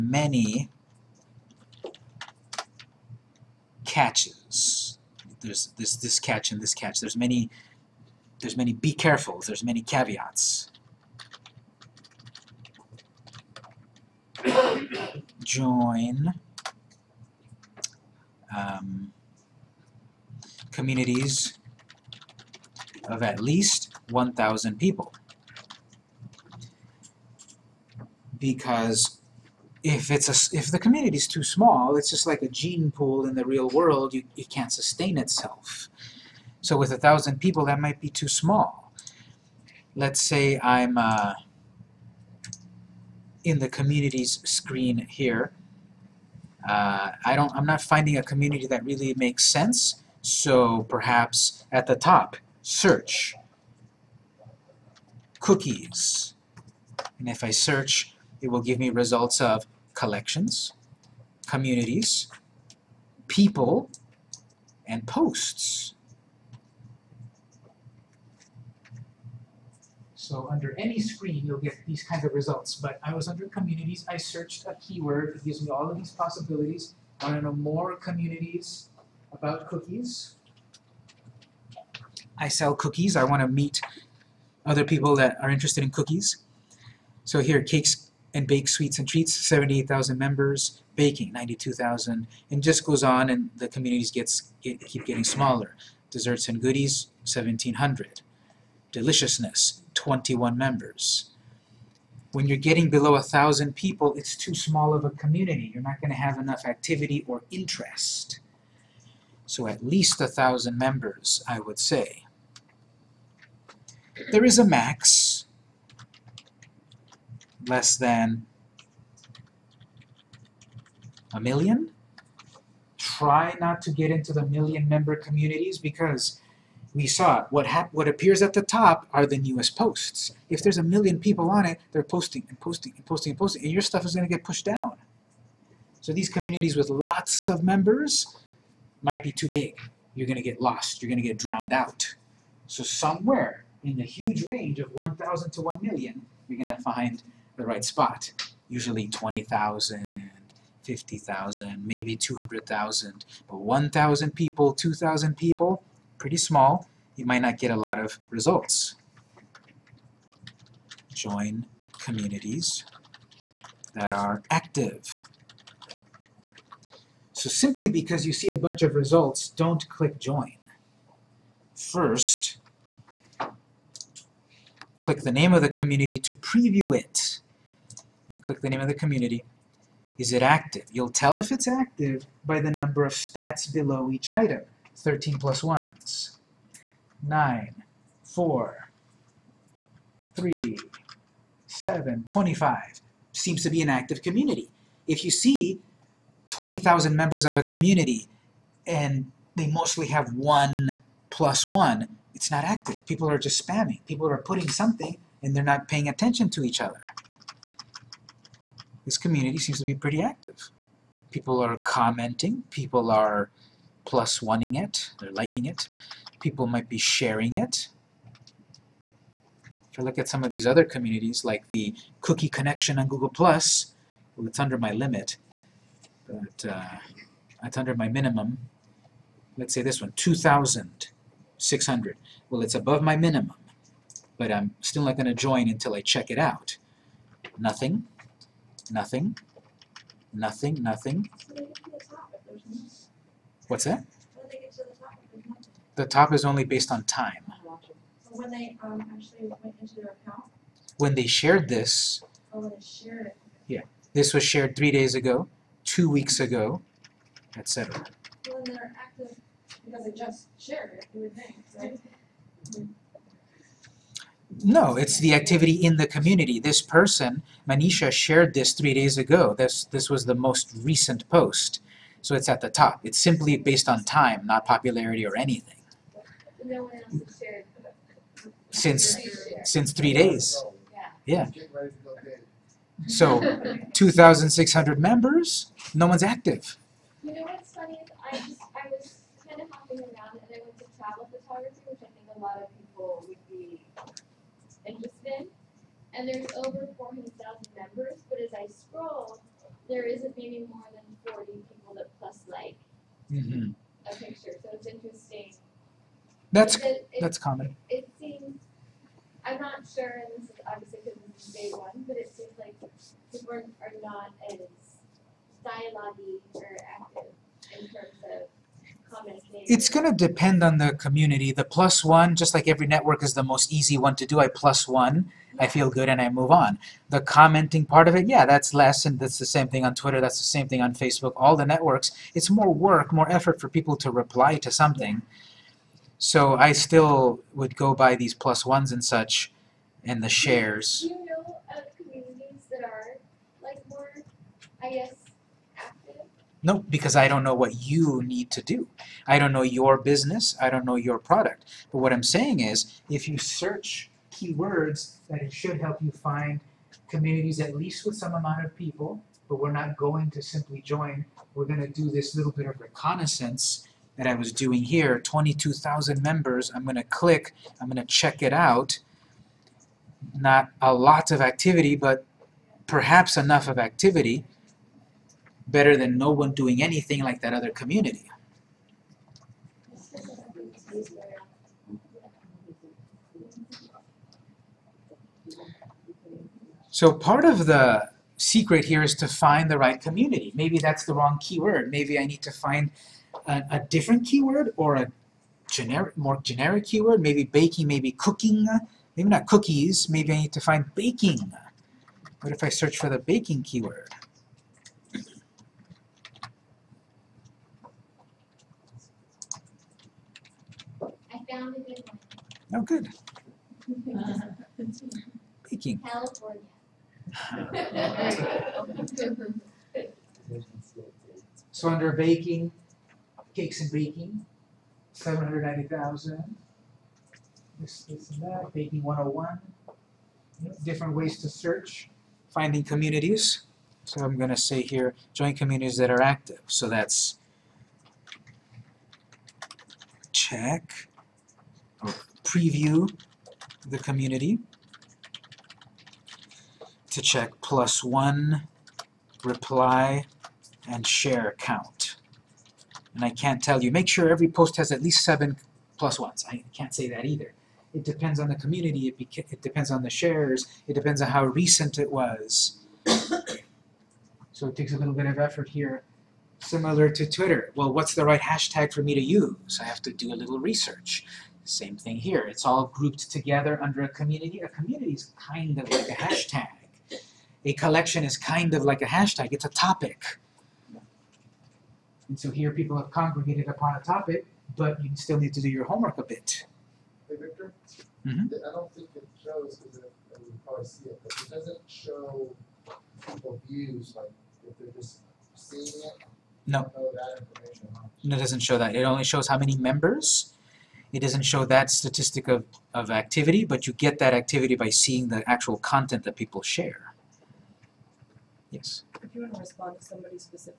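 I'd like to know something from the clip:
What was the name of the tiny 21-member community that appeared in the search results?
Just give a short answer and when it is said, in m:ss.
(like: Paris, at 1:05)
Deliciousness, at 1:38.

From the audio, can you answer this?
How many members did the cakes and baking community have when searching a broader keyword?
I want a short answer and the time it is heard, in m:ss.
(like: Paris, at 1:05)
790,000, at 7:05.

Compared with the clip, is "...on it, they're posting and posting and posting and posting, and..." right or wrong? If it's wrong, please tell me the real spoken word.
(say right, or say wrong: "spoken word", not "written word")
right.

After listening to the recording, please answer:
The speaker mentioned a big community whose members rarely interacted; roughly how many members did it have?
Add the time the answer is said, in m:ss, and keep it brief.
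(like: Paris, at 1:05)
400,000, at 4:56.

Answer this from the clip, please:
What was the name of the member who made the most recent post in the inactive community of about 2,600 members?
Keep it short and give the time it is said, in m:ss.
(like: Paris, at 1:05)
Manisha, at 4:27.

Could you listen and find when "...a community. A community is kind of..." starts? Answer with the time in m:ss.
7:54.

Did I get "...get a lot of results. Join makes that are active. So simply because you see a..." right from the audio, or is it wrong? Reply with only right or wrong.
wrong.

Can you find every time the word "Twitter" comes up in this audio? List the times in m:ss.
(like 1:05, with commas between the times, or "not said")
5:29, 7:47.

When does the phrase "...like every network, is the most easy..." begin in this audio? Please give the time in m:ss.
5:22.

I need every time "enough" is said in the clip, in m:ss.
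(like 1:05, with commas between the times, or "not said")
1:46, 6:13.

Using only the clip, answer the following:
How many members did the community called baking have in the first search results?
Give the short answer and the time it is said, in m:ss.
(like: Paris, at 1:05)
92,000, at 1:31.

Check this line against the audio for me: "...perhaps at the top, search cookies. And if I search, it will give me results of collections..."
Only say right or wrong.
right.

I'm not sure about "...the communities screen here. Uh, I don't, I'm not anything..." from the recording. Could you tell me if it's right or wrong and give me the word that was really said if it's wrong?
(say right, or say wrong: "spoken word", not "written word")
wrong: "finding", not "anything".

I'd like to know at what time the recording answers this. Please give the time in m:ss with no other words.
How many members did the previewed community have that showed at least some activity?
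6:05.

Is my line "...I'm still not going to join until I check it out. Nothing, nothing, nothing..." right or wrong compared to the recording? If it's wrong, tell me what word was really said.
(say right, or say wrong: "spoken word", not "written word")
right.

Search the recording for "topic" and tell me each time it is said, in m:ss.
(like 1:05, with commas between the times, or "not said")
7:59, 8:03.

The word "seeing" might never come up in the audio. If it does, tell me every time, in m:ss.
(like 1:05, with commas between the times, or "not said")
8:15, 8:24.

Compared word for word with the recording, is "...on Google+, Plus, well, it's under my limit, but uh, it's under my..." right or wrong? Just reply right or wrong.
right.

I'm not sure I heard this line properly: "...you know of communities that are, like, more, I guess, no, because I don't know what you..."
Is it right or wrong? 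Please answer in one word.
right.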